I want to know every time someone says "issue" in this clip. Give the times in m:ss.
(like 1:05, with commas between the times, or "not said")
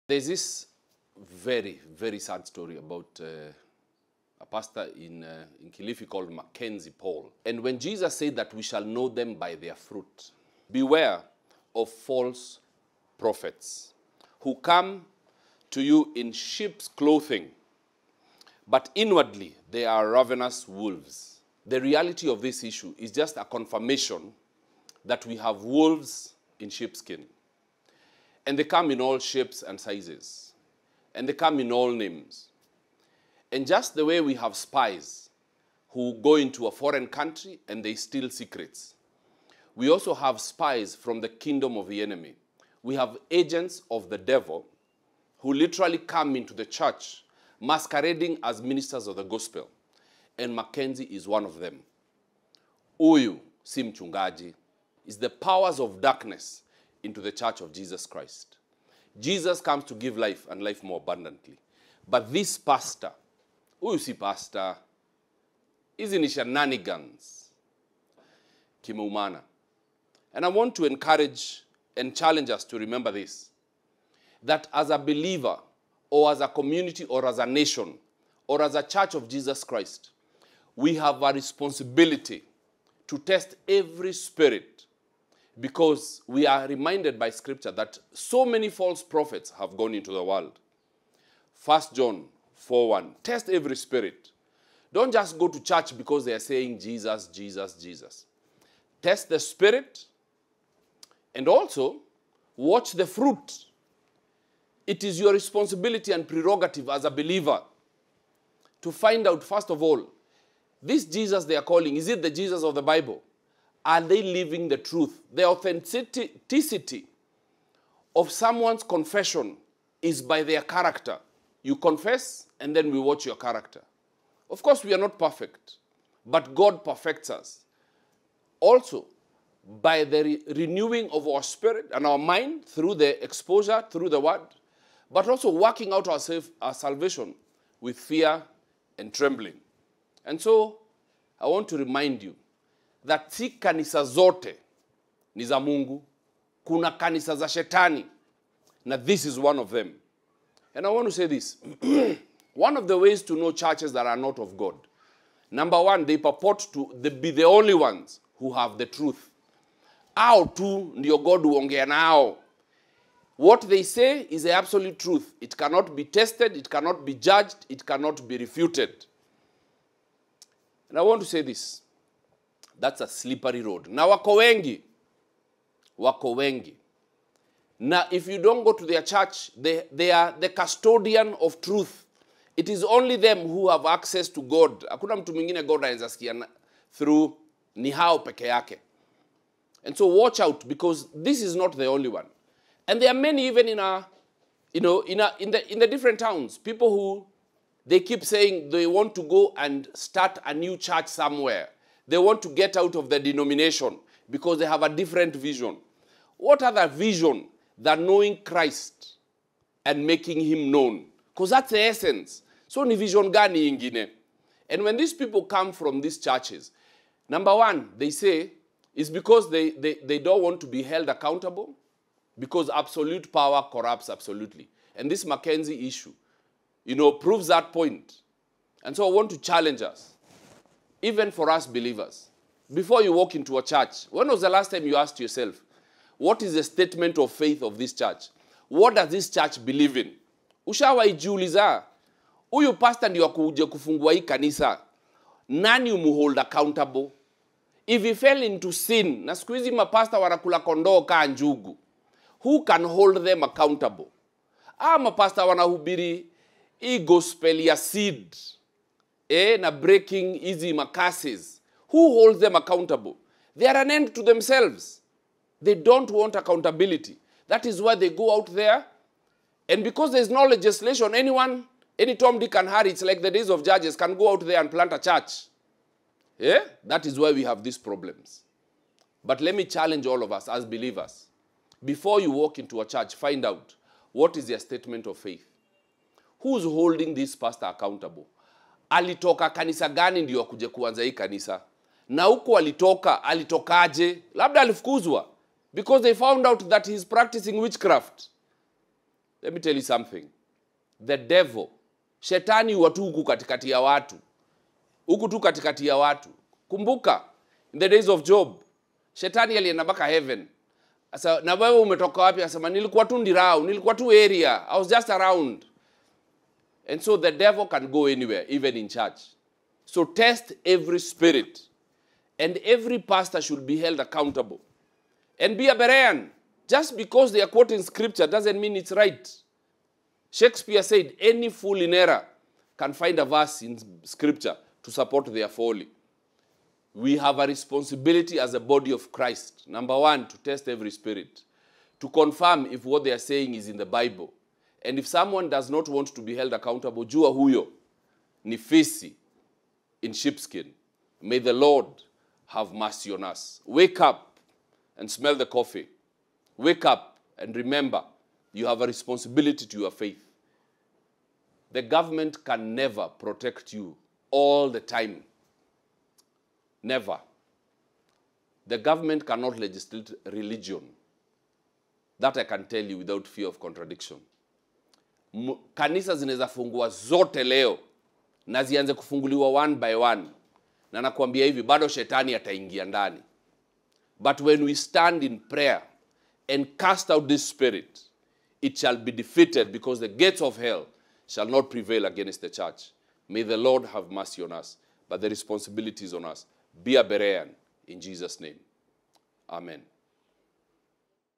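0:22, 3:45.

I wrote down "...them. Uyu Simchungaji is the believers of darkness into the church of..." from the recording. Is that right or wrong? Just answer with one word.
wrong.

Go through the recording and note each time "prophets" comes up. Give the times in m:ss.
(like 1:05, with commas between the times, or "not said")
0:13, 1:29.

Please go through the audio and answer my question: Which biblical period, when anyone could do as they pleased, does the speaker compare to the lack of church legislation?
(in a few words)
The days of judges.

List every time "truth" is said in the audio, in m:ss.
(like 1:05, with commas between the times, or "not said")
1:54, 2:38, 2:44, 3:01.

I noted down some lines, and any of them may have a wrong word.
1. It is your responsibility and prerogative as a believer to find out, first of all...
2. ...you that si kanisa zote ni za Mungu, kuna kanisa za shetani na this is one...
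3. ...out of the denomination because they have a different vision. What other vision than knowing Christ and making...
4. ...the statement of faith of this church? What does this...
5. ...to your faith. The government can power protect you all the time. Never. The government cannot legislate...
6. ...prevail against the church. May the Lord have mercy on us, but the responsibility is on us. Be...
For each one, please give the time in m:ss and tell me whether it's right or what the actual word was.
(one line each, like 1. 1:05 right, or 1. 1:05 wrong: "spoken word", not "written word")
1. 1:44 right
2. 2:22 right
3. 3:22 right
4. 3:56 right
5. 5:59 wrong: "never", not "power"
6. 6:31 right.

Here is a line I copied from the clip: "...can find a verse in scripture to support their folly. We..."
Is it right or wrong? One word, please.
right.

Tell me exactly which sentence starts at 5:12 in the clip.
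asema nilikuwa tu ndirau, nilikuwa tu area, I was just around.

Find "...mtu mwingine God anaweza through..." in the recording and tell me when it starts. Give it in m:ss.
3:05.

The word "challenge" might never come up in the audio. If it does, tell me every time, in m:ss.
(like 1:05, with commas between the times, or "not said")
1:12, 3:49, 4:39.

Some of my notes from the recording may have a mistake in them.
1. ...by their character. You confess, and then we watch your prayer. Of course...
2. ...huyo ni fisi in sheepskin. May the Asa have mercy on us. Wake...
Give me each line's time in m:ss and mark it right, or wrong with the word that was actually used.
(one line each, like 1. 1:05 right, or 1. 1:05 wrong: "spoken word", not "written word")
1. 2:00 wrong: "character", not "prayer"
2. 5:47 wrong: "Lord", not "Asa".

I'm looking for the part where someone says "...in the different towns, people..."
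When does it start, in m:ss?
3:15.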